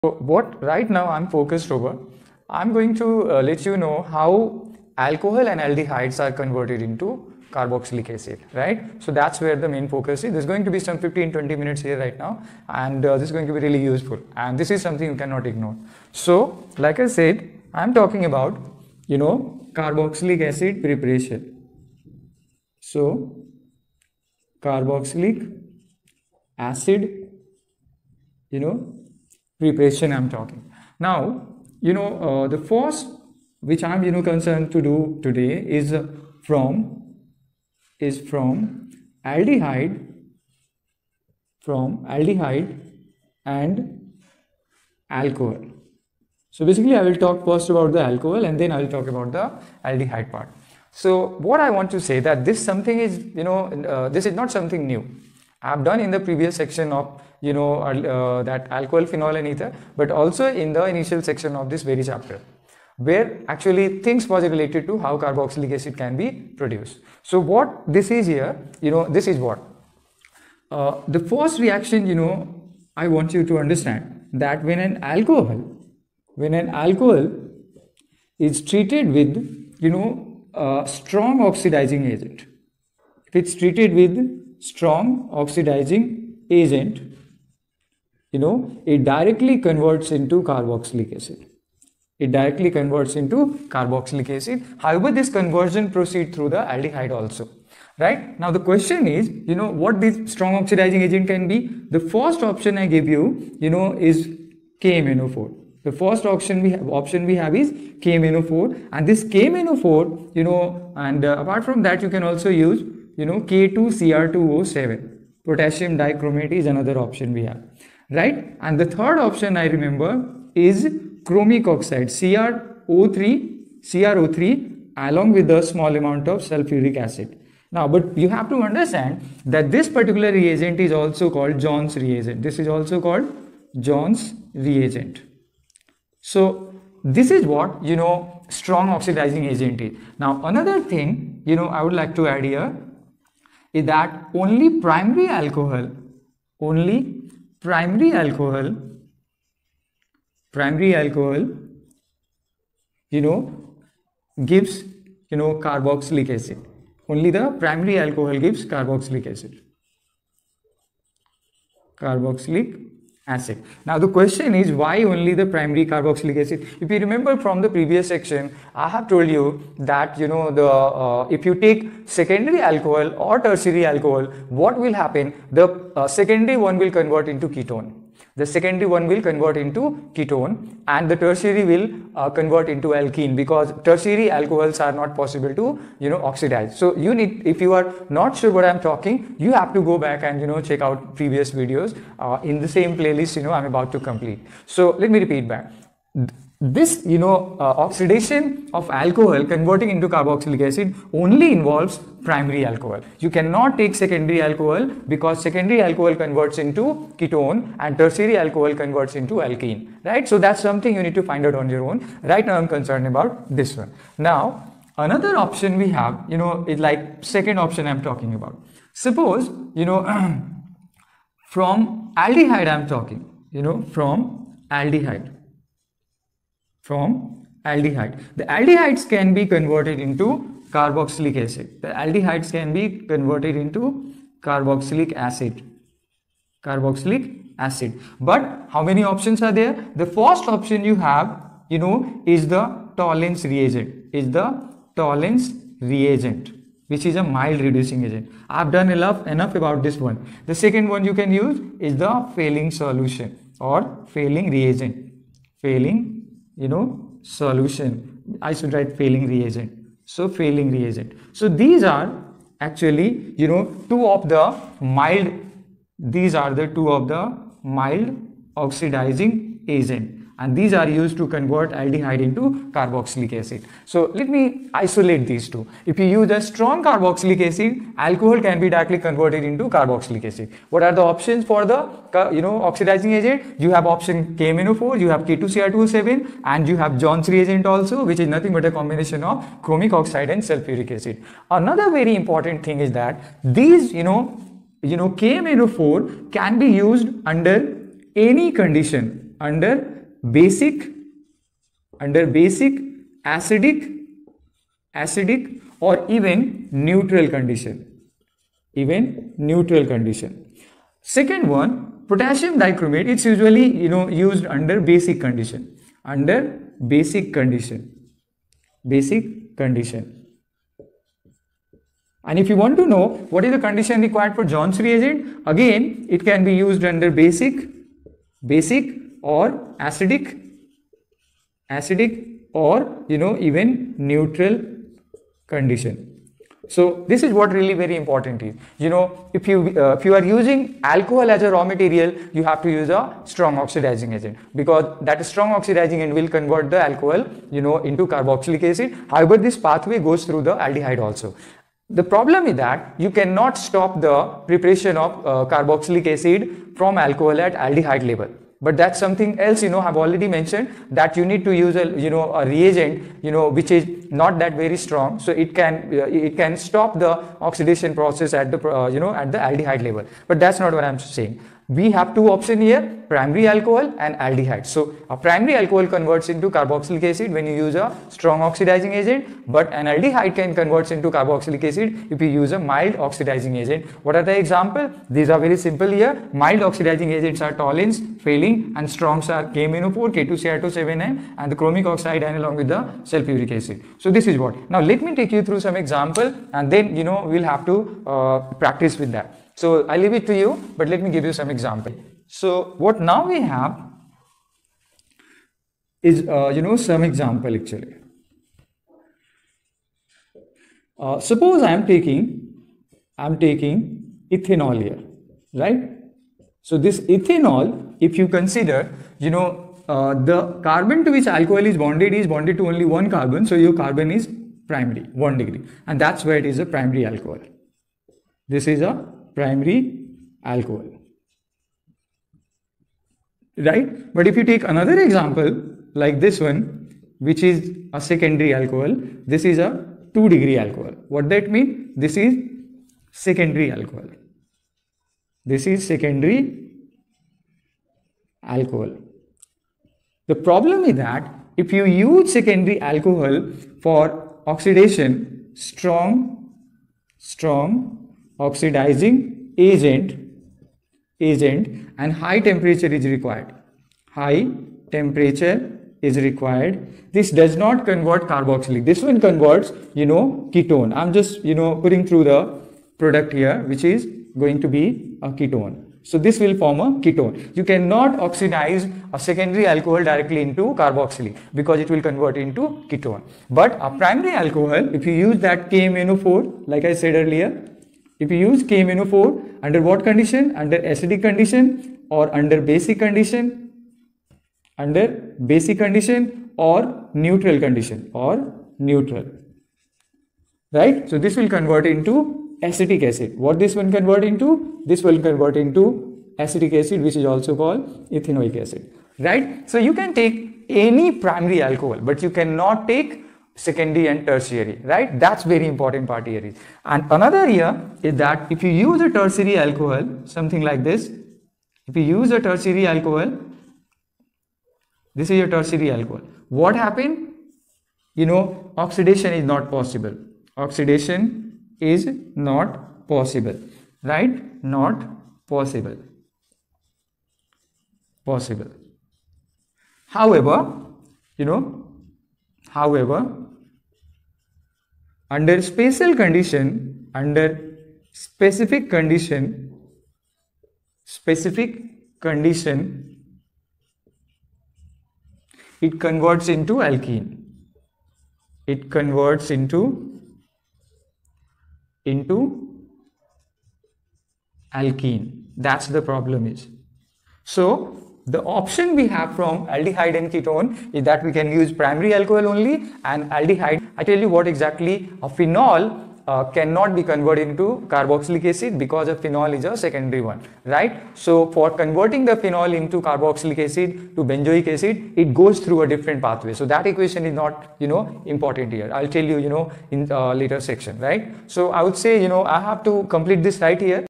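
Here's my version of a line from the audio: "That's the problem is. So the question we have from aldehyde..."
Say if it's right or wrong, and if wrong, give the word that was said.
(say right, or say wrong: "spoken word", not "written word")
wrong: "option", not "question".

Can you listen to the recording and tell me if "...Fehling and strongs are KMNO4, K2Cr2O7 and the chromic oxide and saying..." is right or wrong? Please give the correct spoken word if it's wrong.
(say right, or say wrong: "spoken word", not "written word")
wrong: "along", not "saying".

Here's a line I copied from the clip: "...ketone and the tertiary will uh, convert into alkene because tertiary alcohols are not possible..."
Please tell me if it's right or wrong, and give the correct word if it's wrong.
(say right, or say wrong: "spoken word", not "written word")
right.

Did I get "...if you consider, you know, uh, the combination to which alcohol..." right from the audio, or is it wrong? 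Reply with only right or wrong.
wrong.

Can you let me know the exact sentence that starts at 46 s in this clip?
So basically I will talk first about the alcohol and then I will talk about the aldehyde part.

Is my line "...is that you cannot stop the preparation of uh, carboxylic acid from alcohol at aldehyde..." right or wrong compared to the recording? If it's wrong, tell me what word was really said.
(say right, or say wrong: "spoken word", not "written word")
right.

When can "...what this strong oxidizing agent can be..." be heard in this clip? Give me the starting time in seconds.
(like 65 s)
99 s.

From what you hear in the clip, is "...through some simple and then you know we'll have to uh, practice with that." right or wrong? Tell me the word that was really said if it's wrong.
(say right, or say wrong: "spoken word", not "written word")
wrong: "example", not "simple".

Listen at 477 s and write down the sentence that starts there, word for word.
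You cannot oxidize a secondary alcohol directly into carboxylic because it will convert into ketone.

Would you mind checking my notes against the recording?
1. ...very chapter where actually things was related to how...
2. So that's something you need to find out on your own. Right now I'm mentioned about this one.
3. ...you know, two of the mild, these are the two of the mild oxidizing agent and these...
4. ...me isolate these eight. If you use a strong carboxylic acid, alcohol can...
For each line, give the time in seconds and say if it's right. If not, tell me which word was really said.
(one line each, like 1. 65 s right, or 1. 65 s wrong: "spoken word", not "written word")
1. 61 s right
2. 210 s wrong: "concerned", not "mentioned"
3. 263 s right
4. 274 s wrong: "two", not "eight".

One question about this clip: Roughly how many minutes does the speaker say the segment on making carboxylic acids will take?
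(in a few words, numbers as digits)
15, 20 minutes.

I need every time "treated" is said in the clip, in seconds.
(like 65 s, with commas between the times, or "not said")
78 s, 83 s.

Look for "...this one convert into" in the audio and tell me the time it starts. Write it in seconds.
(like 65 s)
503 s.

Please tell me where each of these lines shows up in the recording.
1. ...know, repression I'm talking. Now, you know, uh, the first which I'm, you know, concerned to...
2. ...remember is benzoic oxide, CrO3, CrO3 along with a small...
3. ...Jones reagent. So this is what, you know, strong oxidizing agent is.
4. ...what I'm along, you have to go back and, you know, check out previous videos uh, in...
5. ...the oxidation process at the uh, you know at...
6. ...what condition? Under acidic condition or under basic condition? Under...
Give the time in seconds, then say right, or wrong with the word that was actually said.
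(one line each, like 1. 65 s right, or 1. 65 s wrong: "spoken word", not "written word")
1. 28 s right
2. 119 s wrong: "chromic", not "benzoic"
3. 133 s right
4. 188 s wrong: "talking", not "along"
5. 366 s right
6. 489 s right.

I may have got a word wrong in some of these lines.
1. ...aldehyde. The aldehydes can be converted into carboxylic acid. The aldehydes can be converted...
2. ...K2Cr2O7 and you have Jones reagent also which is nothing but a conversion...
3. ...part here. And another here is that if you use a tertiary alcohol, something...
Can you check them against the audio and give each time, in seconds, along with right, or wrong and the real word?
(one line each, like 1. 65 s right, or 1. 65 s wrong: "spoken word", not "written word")
1. 227 s right
2. 285 s wrong: "combination", not "conversion"
3. 516 s right.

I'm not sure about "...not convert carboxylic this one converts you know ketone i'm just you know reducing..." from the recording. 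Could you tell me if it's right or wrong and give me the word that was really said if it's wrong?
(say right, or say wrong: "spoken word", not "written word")
wrong: "putting", not "reducing".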